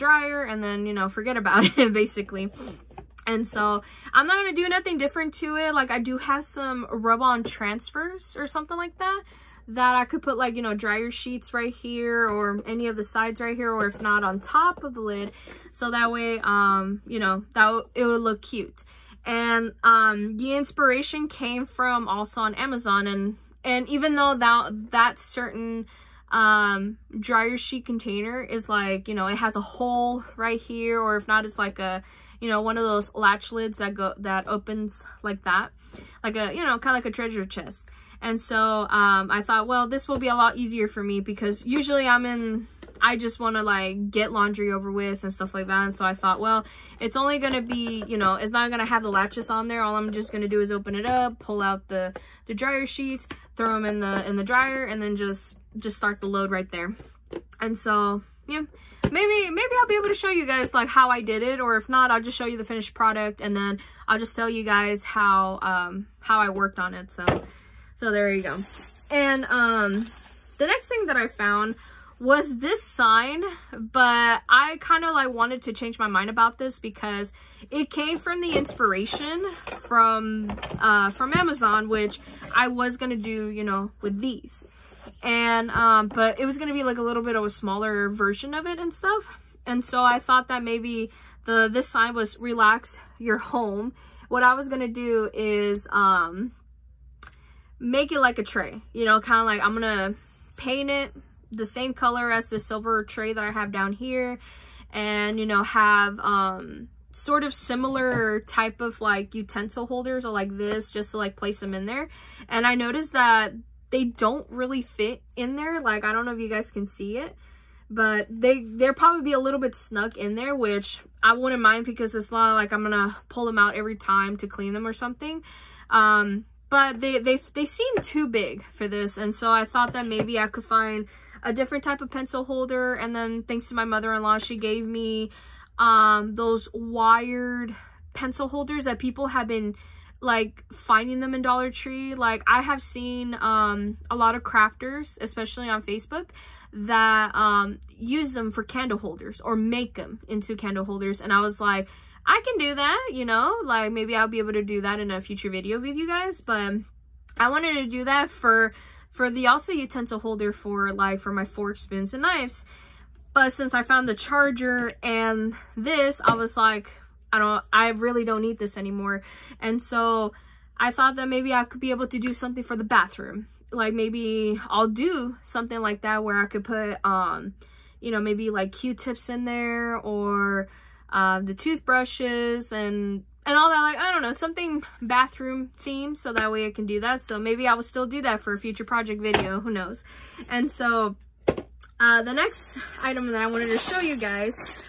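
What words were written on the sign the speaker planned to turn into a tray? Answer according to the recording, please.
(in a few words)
relax your home.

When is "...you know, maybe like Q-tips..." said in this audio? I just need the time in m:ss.
2:57.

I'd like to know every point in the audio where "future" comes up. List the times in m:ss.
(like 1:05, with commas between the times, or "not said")
2:35, 3:08.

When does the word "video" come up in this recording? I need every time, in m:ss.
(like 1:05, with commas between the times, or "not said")
2:35, 3:09.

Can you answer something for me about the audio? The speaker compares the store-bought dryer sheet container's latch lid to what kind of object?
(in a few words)
a treasure chest.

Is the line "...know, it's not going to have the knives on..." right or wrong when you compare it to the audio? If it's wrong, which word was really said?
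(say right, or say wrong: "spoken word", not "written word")
wrong: "latches", not "knives".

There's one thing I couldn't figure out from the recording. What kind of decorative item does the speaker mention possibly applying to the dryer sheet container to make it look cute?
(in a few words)
rub-on transfers.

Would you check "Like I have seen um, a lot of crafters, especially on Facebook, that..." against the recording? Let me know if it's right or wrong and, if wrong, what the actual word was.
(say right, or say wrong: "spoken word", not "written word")
right.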